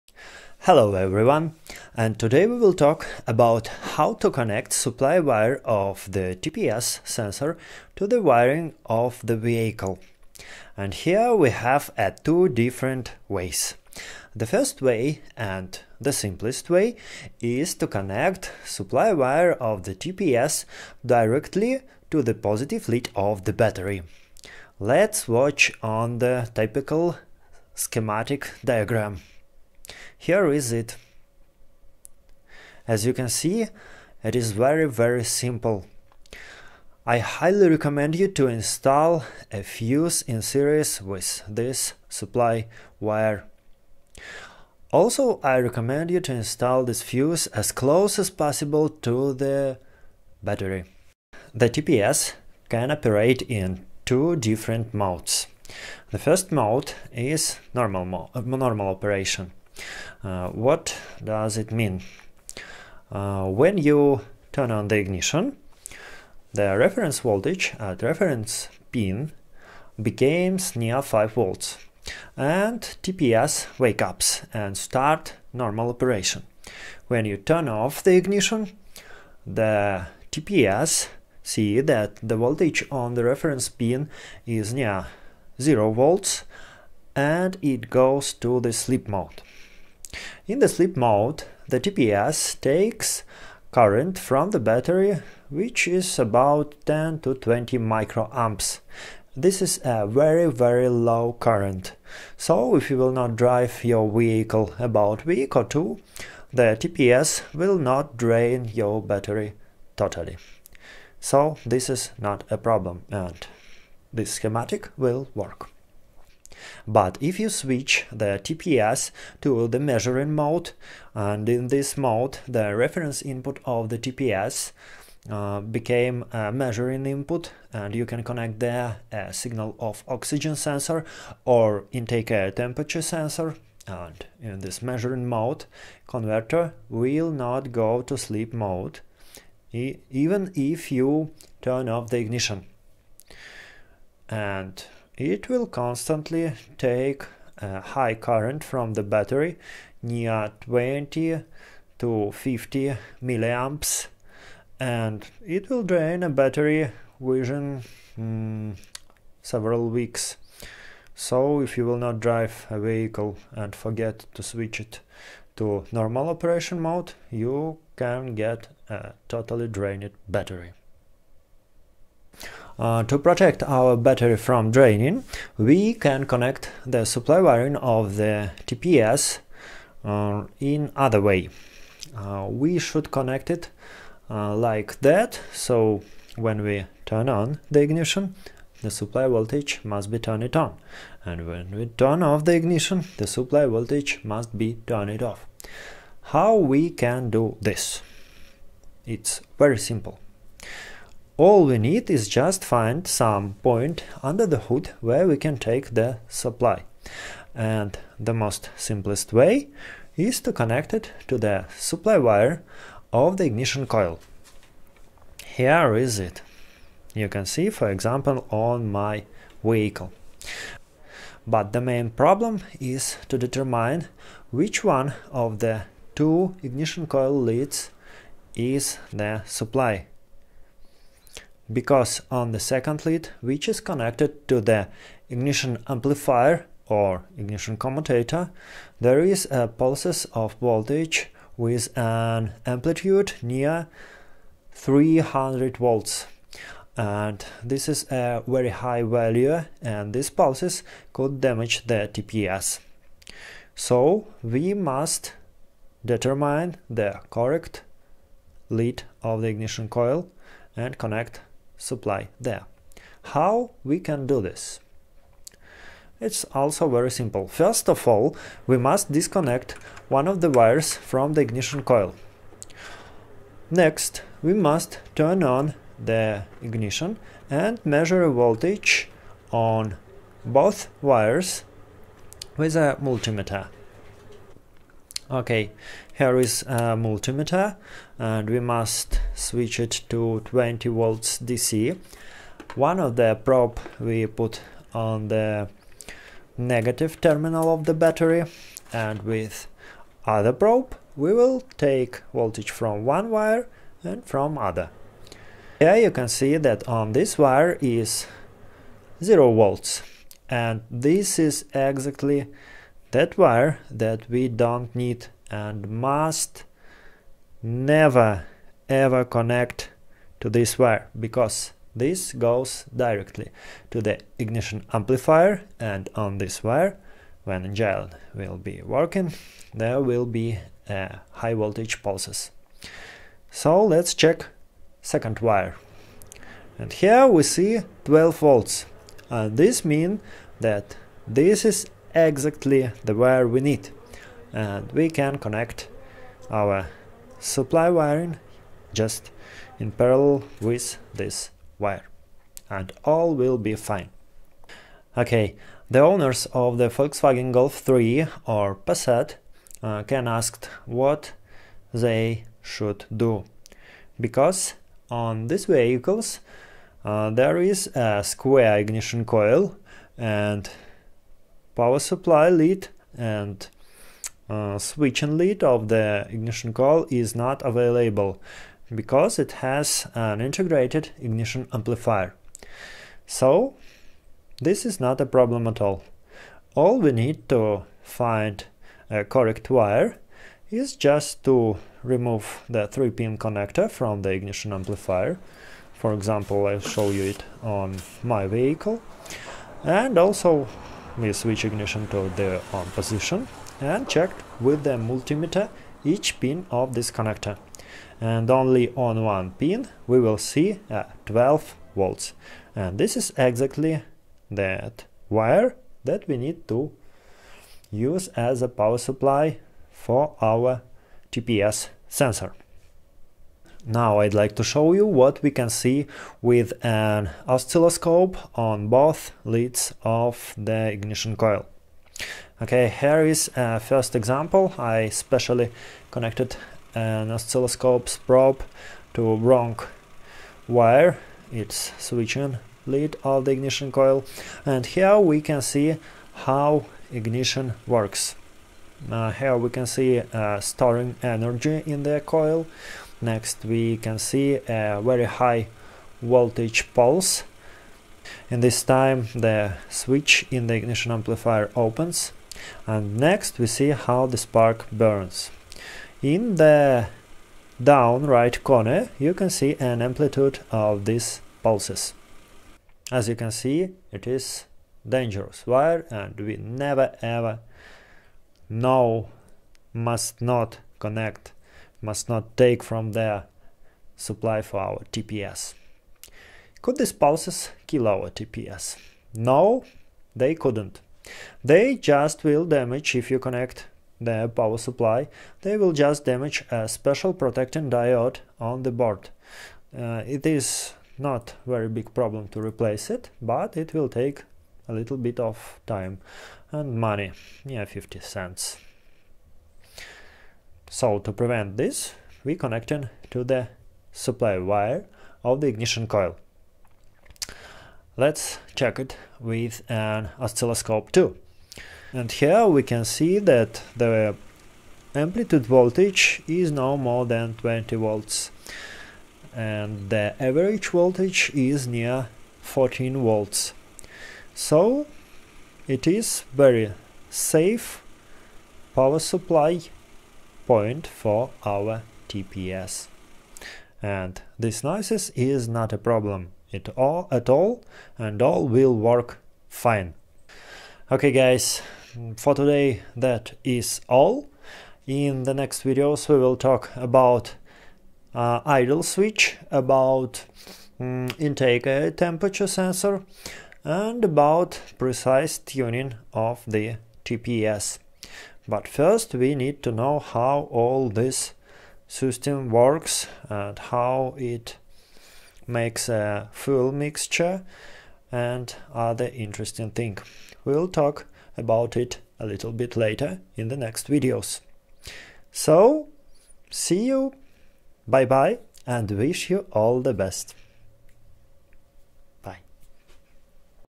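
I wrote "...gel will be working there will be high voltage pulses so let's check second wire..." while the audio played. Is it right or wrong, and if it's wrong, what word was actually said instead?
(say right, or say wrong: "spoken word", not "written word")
right.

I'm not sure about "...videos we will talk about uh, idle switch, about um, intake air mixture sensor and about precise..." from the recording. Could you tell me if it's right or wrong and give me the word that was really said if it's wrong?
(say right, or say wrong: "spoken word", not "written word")
wrong: "temperature", not "mixture".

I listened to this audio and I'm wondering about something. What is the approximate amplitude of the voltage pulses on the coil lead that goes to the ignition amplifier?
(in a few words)
300 volts.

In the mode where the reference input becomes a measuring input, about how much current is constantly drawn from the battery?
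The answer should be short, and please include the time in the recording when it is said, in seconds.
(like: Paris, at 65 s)
20 to 50 milliamps, at 150 s.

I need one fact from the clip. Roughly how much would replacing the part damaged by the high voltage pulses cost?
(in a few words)
50 cents.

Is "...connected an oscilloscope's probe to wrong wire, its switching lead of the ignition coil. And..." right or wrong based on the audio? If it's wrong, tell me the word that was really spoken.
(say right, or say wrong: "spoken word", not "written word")
right.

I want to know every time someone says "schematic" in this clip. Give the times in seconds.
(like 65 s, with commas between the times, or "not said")
27 s, 114 s.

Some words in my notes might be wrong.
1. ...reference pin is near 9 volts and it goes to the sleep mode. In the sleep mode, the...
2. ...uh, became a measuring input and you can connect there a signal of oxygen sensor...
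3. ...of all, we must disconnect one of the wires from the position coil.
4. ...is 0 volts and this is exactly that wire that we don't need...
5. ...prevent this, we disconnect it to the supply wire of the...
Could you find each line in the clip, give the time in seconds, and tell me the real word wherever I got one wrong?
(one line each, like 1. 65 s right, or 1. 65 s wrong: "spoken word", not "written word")
1. 83 s wrong: "0", not "9"
2. 125 s right
3. 267 s wrong: "ignition", not "position"
4. 307 s right
5. 511 s wrong: "connect", not "disconnect".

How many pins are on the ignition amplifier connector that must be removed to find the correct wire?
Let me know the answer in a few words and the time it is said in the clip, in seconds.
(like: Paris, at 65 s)
3, at 392 s.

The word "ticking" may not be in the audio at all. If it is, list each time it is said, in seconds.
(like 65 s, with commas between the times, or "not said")
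not said.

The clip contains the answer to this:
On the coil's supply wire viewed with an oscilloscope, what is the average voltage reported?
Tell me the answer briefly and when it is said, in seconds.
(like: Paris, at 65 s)
14 volts, at 532 s.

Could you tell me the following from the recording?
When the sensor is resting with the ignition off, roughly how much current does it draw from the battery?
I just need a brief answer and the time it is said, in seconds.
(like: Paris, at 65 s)
10 to 20 microamps, at 96 s.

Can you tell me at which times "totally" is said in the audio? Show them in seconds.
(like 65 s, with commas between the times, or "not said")
109 s, 169 s.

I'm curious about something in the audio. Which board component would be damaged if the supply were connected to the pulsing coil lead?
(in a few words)
protecting diode.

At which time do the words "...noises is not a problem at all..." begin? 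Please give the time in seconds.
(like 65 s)
544 s.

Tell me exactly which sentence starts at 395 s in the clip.
For example, I'll show you it on my vehicle.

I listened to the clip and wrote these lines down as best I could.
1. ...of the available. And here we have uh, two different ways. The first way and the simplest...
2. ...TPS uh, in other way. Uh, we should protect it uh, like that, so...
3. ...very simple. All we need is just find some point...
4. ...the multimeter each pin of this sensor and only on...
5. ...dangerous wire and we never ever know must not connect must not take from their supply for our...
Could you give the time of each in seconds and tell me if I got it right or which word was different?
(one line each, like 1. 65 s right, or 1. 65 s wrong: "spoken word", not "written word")
1. 8 s wrong: "vehicle", not "available"
2. 178 s wrong: "connect", not "protect"
3. 199 s right
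4. 404 s wrong: "connector", not "sensor"
5. 475 s right.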